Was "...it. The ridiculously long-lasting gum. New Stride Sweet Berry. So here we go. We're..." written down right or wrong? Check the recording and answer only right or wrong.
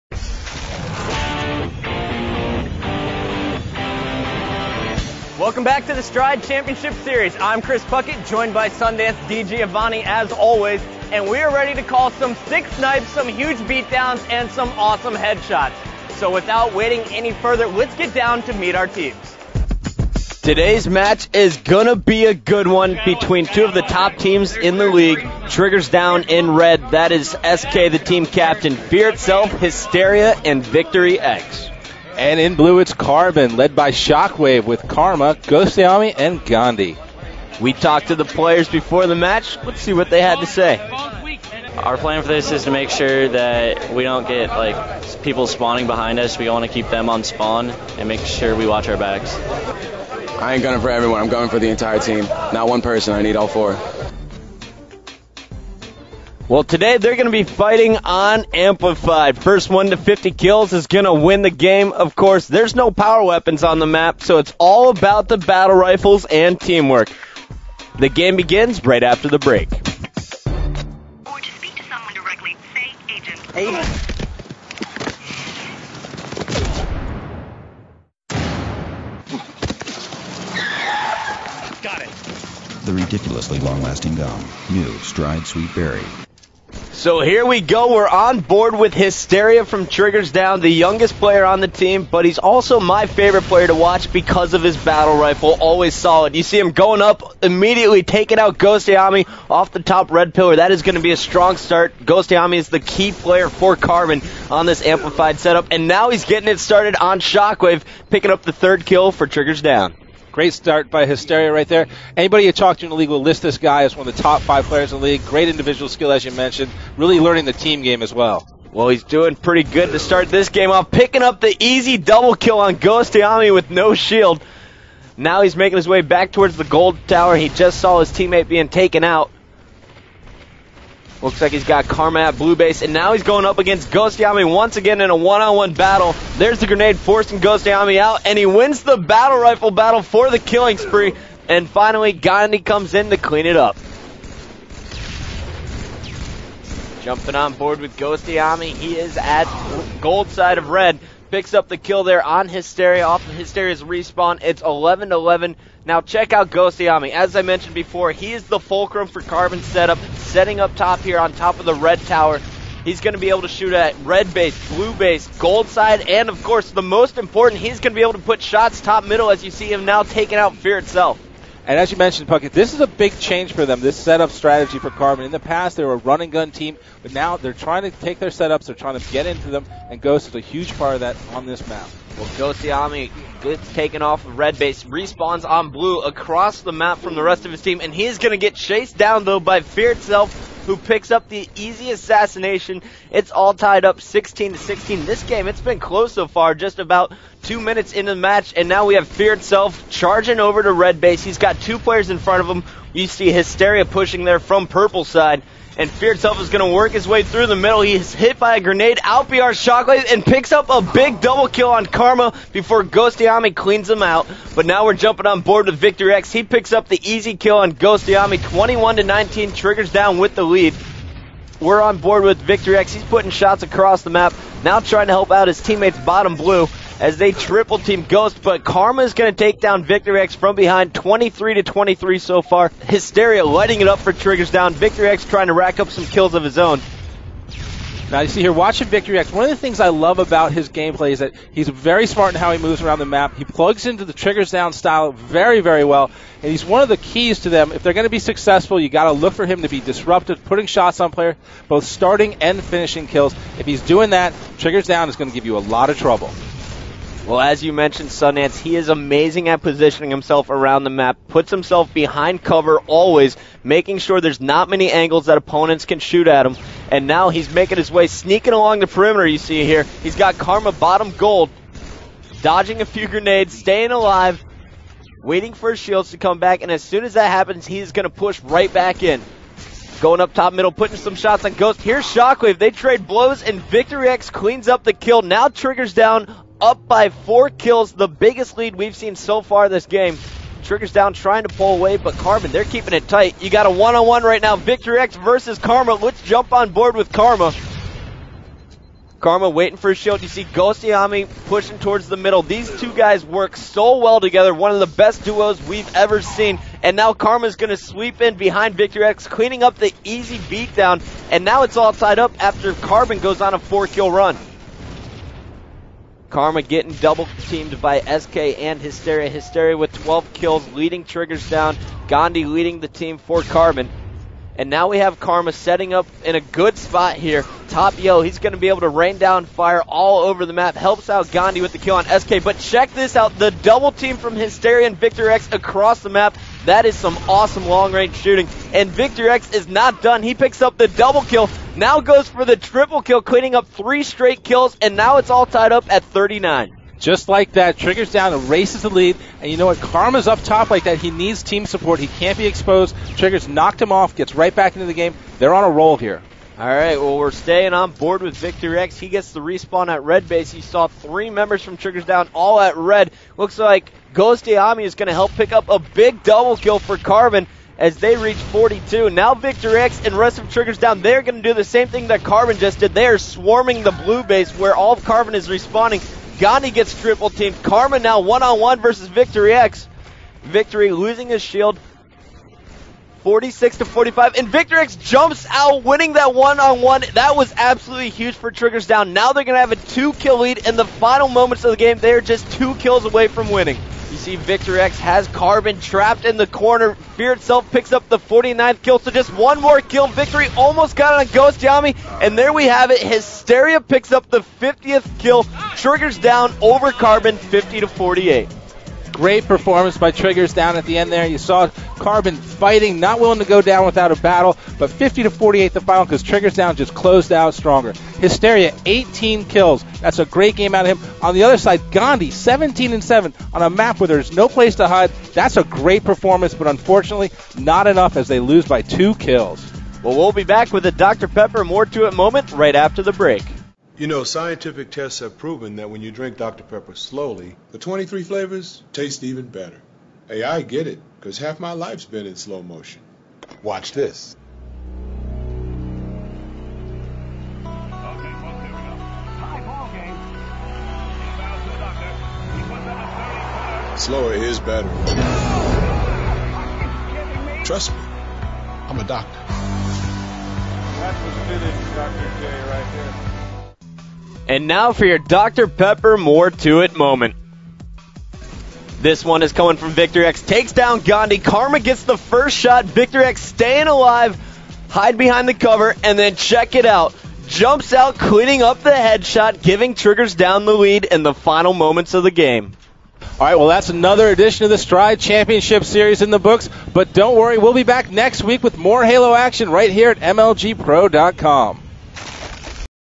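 right.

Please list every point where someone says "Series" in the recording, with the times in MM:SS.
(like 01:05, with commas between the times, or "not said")
00:07, 08:05.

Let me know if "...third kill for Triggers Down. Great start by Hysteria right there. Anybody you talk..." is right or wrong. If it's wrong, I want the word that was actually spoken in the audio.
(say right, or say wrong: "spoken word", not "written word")
right.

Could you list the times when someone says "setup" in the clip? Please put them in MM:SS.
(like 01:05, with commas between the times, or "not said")
01:45, 02:39, 02:53, 02:58.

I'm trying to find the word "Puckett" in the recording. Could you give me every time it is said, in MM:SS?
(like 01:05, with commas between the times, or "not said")
00:07, 02:52.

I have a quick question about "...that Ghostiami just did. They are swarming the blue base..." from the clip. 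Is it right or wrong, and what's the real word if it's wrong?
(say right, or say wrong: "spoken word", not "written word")
wrong: "Carbon", not "Ghostiami".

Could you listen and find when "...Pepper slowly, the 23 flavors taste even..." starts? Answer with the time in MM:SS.
07:16.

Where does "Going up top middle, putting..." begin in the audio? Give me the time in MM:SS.
04:40.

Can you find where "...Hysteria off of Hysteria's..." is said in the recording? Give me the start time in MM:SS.
02:32.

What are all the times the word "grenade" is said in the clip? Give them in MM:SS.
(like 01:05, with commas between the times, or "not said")
02:16, 03:28, 04:33.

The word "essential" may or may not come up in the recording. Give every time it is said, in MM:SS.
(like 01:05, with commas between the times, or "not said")
not said.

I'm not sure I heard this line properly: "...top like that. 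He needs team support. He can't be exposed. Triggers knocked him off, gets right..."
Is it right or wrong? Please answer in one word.
right.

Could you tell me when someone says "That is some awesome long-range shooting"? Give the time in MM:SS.
05:36.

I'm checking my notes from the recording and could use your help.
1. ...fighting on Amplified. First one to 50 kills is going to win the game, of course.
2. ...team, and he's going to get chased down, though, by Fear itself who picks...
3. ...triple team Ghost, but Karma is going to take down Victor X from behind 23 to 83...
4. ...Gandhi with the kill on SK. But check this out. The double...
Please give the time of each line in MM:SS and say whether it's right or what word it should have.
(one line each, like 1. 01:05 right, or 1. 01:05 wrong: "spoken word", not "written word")
1. 00:57 right
2. 03:07 right
3. 03:47 wrong: "23", not "83"
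4. 05:31 right.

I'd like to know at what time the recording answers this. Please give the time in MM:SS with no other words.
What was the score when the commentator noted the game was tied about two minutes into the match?
03:14.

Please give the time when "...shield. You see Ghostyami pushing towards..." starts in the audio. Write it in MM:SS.
04:59.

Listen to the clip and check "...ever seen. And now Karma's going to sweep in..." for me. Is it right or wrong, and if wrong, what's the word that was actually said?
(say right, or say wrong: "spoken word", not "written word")
right.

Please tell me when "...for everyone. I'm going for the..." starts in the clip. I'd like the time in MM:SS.
00:50.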